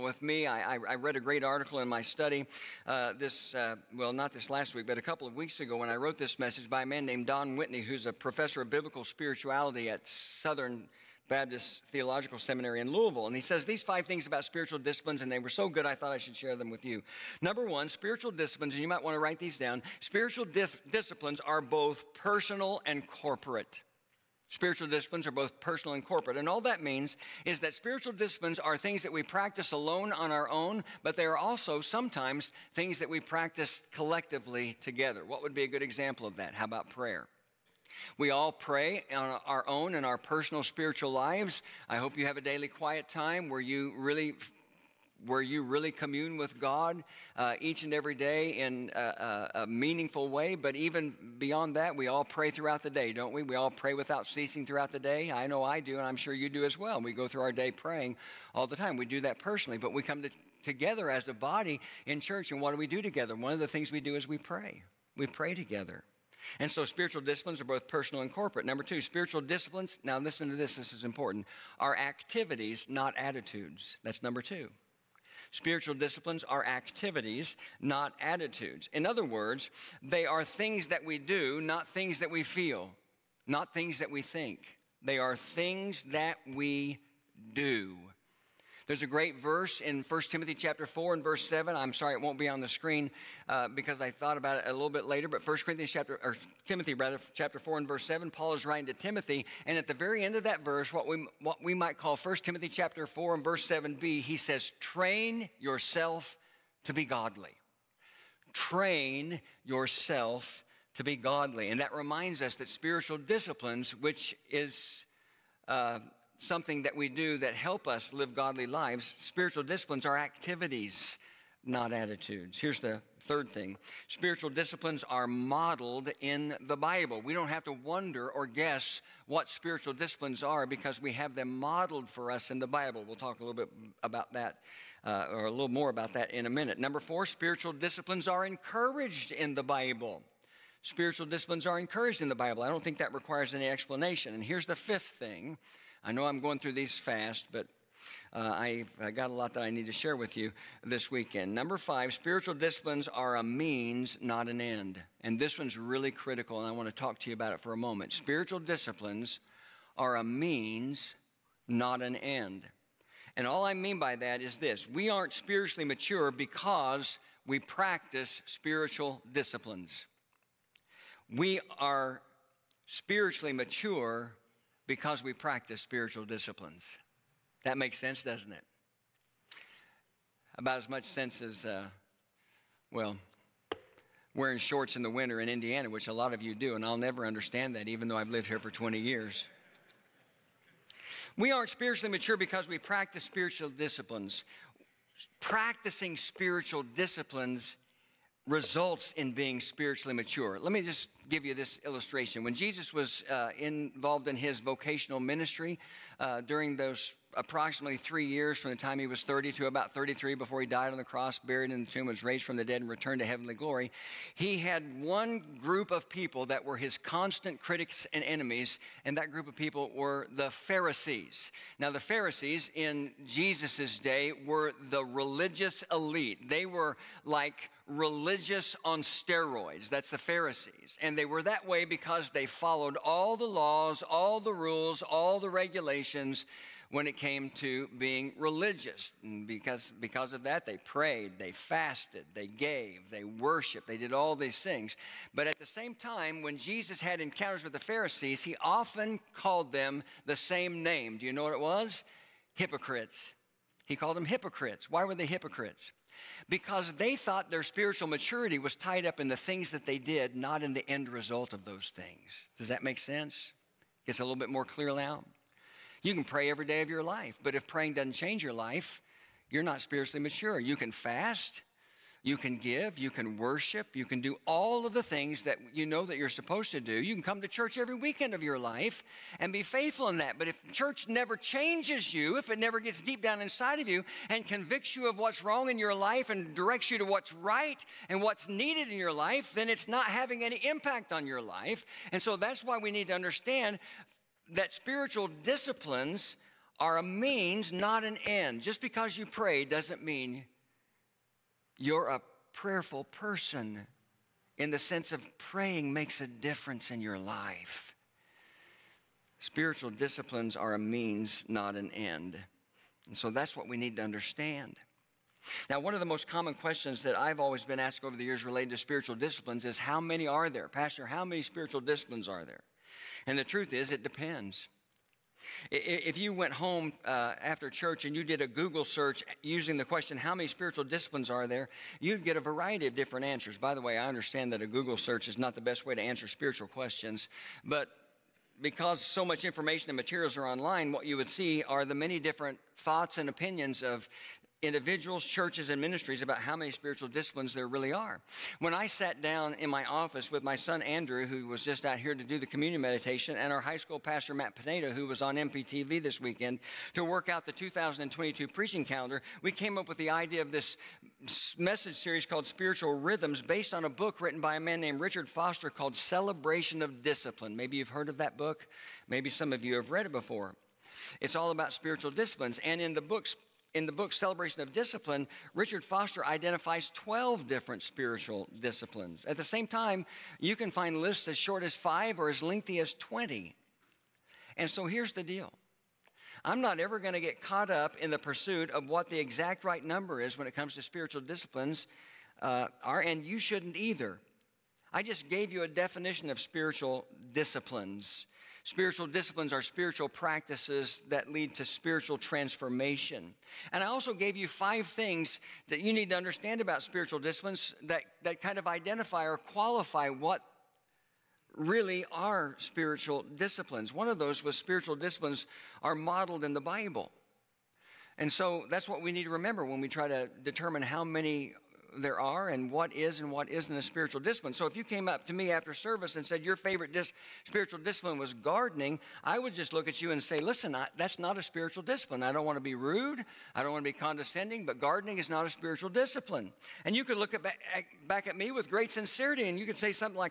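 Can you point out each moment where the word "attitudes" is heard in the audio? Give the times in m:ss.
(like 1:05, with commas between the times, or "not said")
1:13, 1:18, 2:01.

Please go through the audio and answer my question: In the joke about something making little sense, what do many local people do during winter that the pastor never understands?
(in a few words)
Wearing shorts.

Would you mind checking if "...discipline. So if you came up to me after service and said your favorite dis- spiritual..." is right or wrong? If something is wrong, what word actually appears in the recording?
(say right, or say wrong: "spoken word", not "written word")
right.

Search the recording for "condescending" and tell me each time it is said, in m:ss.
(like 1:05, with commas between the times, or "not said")
7:13.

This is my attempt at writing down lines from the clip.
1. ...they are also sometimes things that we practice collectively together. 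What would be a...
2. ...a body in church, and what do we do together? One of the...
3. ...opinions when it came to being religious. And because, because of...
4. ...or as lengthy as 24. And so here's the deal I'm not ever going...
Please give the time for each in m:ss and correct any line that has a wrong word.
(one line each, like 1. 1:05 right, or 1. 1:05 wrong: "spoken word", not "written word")
1. 0:31 right
2. 1:01 right
3. 3:55 wrong: "regulations", not "opinions"
4. 6:22 wrong: "20", not "24".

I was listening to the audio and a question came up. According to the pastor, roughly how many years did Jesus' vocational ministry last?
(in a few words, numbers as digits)
3 years.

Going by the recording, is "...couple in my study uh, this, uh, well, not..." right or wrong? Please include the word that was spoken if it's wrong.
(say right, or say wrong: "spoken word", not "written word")
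wrong: "article", not "couple".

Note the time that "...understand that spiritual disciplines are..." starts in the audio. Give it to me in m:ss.
4:53.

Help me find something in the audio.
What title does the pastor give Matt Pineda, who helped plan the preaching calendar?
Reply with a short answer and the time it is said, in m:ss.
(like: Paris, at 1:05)
High school pastor, at 5:53.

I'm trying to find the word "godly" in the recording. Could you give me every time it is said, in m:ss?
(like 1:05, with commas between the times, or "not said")
1:47, 1:51, 1:58.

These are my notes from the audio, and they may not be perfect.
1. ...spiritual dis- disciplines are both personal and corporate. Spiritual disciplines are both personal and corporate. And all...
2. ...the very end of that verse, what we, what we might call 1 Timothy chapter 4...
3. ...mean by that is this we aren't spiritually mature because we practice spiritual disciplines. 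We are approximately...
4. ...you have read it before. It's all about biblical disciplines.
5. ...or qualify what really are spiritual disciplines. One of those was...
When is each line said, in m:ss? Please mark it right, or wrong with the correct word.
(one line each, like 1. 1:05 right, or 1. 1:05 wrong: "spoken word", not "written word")
1. 0:20 right
2. 1:39 right
3. 2:43 wrong: "spiritually", not "approximately"
4. 6:09 wrong: "spiritual", not "biblical"
5. 6:49 right.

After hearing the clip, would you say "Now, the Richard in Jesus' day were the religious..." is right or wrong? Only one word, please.
wrong.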